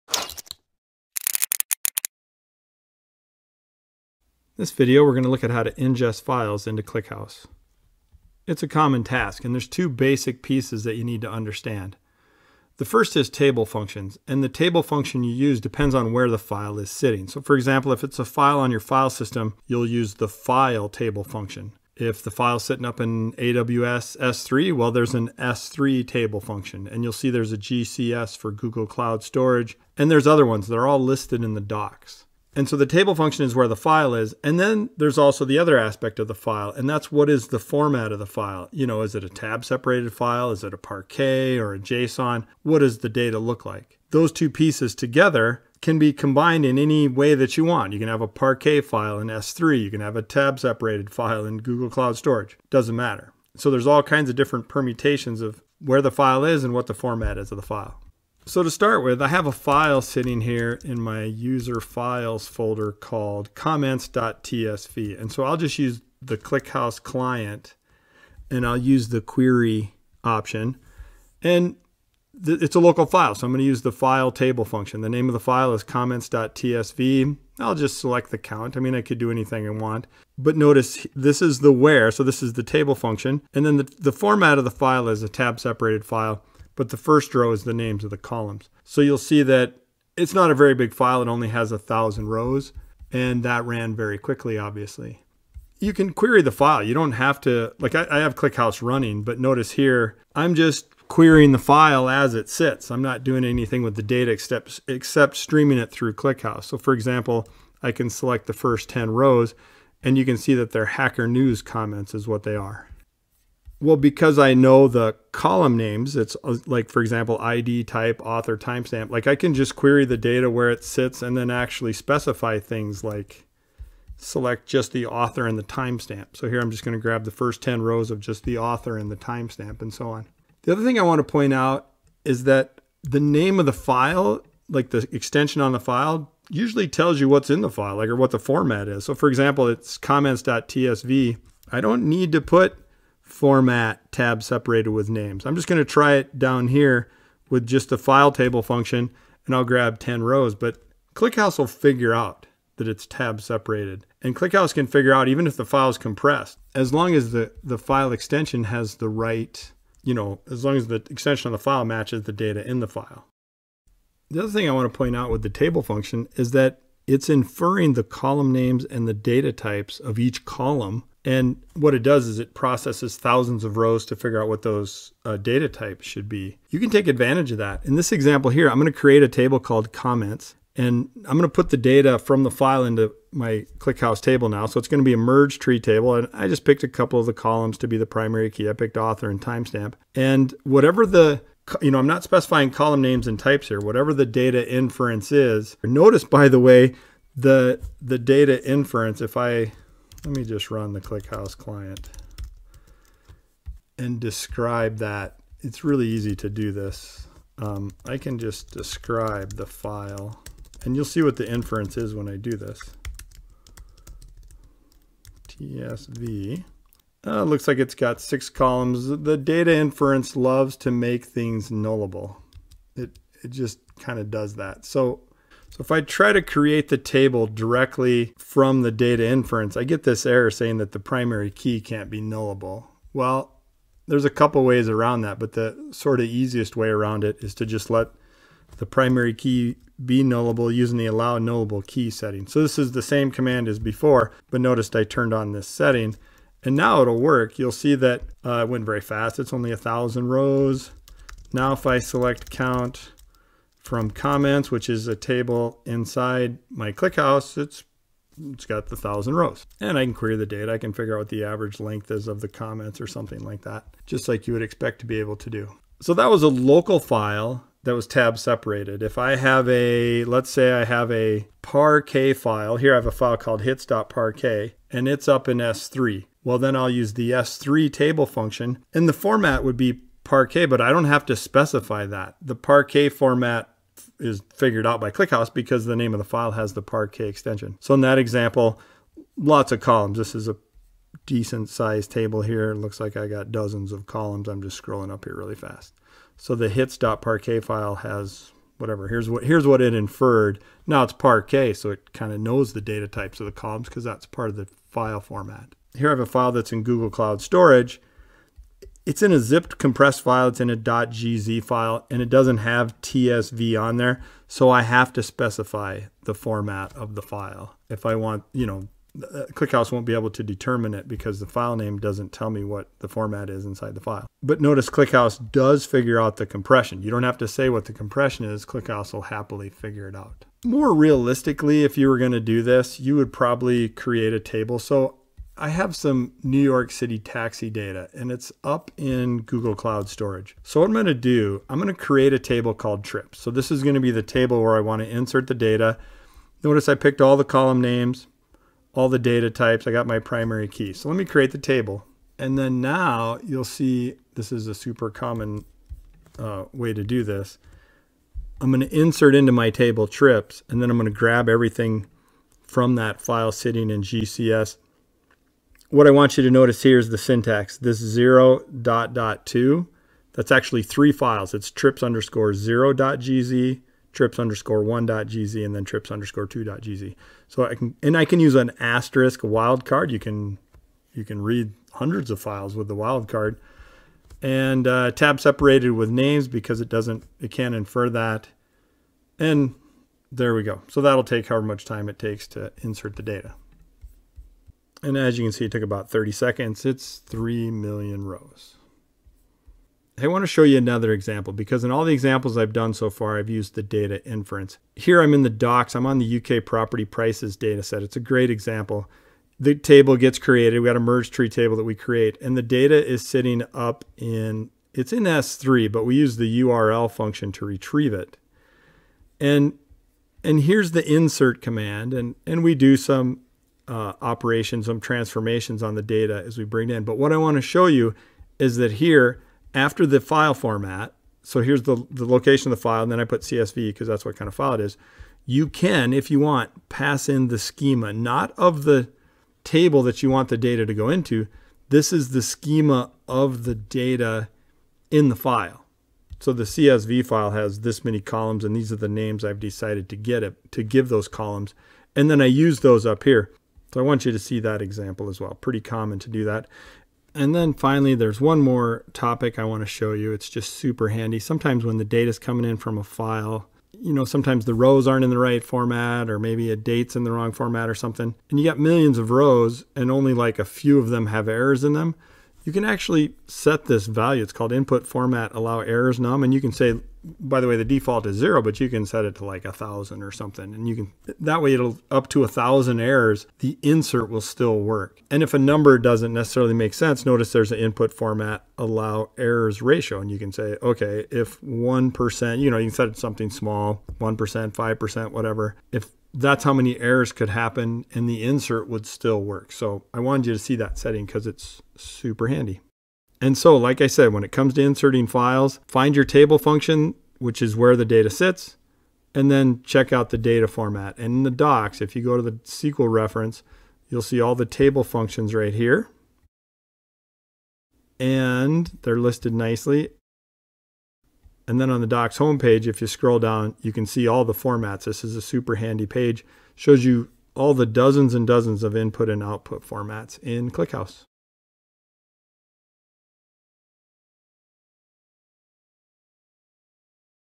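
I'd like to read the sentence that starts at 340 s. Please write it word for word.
So what I'm gonna do, I'm gonna create a table called trips.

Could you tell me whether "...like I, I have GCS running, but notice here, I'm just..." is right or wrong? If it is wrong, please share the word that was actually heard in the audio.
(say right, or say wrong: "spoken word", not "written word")
wrong: "ClickHouse", not "GCS".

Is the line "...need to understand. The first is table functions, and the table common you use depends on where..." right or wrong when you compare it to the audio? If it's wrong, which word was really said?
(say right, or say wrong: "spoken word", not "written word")
wrong: "function", not "common".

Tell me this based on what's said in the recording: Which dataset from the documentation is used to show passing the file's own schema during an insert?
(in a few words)
UK property prices.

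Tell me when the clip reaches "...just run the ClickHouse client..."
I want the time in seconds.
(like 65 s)
200 s.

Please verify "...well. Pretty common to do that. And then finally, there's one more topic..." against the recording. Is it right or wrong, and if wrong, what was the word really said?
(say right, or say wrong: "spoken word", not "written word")
right.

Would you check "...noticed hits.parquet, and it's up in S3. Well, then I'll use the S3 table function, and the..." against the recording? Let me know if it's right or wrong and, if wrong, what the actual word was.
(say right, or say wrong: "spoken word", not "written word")
wrong: "called", not "noticed".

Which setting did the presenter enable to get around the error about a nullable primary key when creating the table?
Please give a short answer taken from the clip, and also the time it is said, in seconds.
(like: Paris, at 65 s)
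allow nullable key, at 241 s.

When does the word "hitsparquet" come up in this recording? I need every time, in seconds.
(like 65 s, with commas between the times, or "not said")
273 s, 296 s.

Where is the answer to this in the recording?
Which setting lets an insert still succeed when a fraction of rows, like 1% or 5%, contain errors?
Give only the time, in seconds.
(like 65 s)
487 s.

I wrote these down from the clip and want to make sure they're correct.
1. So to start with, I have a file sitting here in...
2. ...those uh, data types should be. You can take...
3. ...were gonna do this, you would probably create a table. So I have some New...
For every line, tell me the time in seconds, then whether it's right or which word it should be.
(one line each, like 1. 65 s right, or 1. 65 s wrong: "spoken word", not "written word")
1. 58 s right
2. 174 s right
3. 332 s right.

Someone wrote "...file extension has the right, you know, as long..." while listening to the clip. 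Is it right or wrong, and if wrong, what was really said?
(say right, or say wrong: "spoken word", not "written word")
right.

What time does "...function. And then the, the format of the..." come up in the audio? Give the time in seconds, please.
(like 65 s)
82 s.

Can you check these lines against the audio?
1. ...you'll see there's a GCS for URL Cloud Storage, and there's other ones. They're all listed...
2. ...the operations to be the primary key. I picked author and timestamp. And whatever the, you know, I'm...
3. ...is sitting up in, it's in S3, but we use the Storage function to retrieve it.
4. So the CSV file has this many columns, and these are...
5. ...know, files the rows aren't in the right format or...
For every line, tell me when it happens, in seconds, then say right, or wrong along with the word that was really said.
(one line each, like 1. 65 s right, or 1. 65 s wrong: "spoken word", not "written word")
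1. 27 s wrong: "Google", not "URL"
2. 187 s wrong: "columns", not "operations"
3. 413 s wrong: "URL", not "Storage"
4. 446 s right
5. 464 s wrong: "sometimes", not "files".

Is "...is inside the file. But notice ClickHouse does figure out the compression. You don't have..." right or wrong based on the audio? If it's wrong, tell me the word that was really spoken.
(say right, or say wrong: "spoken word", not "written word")
right.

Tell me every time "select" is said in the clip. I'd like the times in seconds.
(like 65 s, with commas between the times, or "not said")
77 s, 108 s, 124 s, 251 s.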